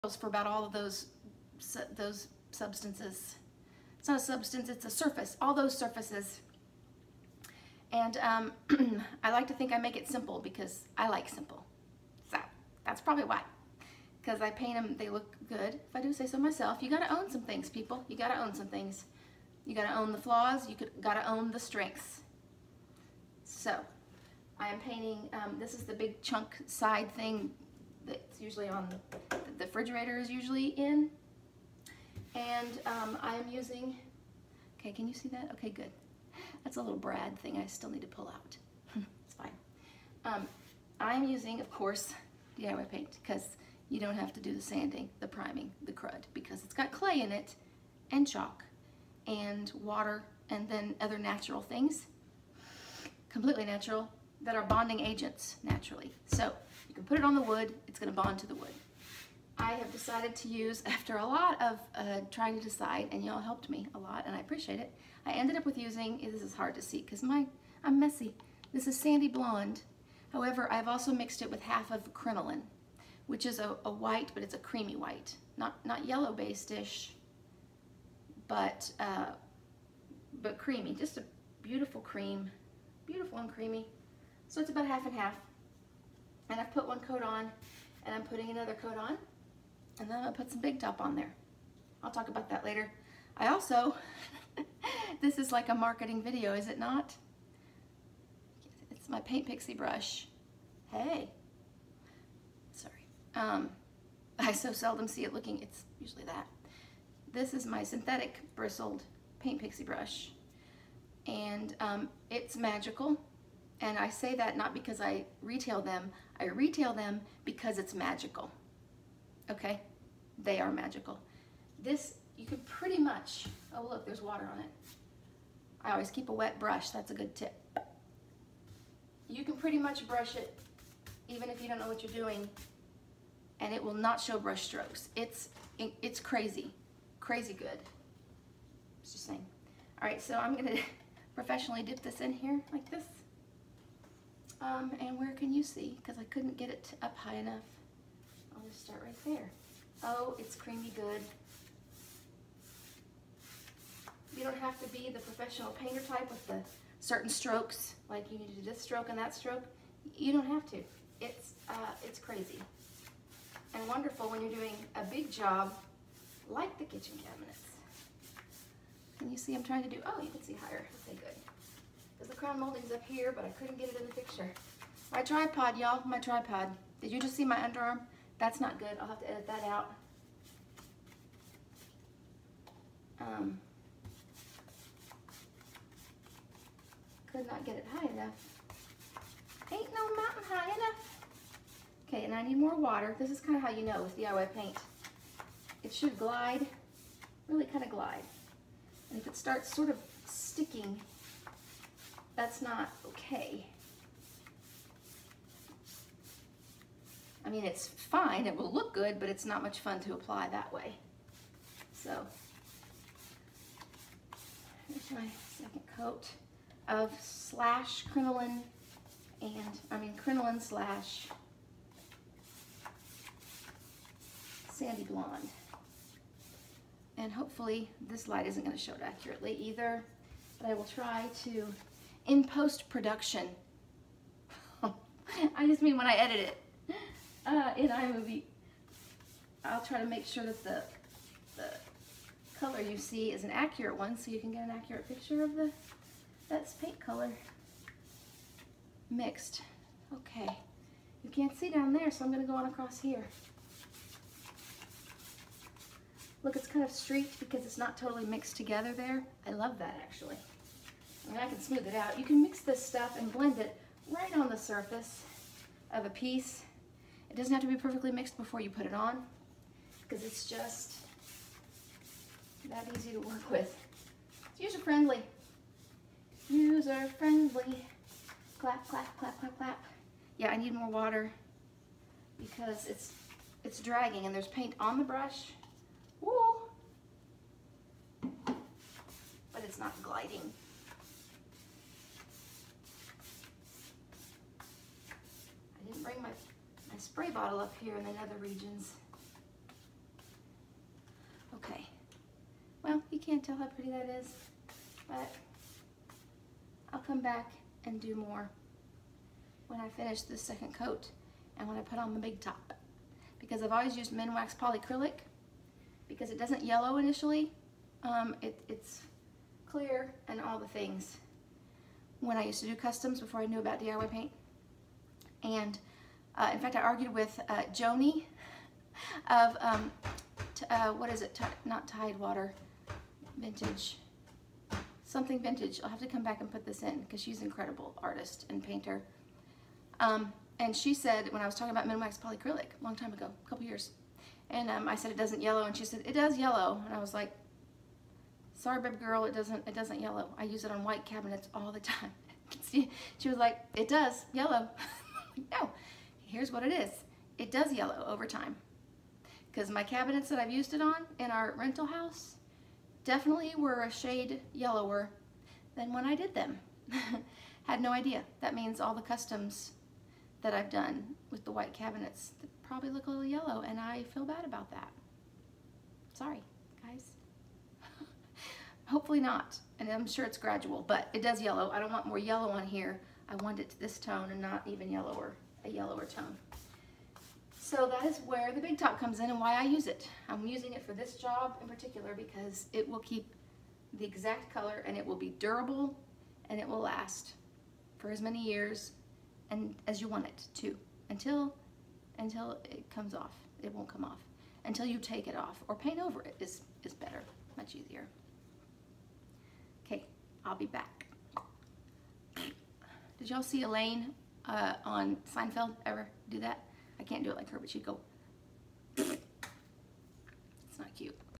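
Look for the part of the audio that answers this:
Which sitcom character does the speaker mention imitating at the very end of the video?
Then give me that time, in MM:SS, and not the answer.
06:53.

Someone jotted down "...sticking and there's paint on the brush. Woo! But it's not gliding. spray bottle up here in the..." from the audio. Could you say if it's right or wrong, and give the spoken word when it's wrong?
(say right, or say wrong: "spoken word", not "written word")
wrong: "dragging", not "sticking".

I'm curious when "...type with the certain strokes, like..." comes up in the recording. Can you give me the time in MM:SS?
02:36.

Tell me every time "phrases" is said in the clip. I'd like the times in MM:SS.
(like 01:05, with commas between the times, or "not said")
not said.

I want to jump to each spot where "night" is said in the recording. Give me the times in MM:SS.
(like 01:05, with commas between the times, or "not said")
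not said.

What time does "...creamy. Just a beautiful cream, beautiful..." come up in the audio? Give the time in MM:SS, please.
01:20.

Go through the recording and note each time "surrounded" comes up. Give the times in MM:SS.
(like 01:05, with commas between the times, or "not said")
not said.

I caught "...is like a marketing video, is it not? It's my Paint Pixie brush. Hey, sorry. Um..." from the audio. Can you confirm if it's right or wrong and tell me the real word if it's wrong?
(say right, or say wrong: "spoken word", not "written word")
right.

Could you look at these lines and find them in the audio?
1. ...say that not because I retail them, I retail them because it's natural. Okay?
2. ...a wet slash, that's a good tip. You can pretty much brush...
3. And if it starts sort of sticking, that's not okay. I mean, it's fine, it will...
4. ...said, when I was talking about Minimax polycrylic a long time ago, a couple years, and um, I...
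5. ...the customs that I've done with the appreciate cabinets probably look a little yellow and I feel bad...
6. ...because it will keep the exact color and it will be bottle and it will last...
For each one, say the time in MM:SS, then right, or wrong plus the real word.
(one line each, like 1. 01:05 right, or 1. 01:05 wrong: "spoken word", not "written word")
1. 01:54 wrong: "magical", not "natural"
2. 02:06 wrong: "brush", not "slash"
3. 03:19 right
4. 05:40 right
5. 06:08 wrong: "white", not "appreciate"
6. 06:32 wrong: "durable", not "bottle".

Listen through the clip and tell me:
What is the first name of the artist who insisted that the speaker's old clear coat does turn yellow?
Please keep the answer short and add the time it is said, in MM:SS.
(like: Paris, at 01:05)
Joni, at 05:27.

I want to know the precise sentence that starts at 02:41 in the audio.
It's, uh, it's crazy and wonderful when you're doing a big job like the kitchen cabinets.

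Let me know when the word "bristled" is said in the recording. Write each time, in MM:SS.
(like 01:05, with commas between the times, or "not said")
01:48.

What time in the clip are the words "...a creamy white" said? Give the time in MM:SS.
01:14.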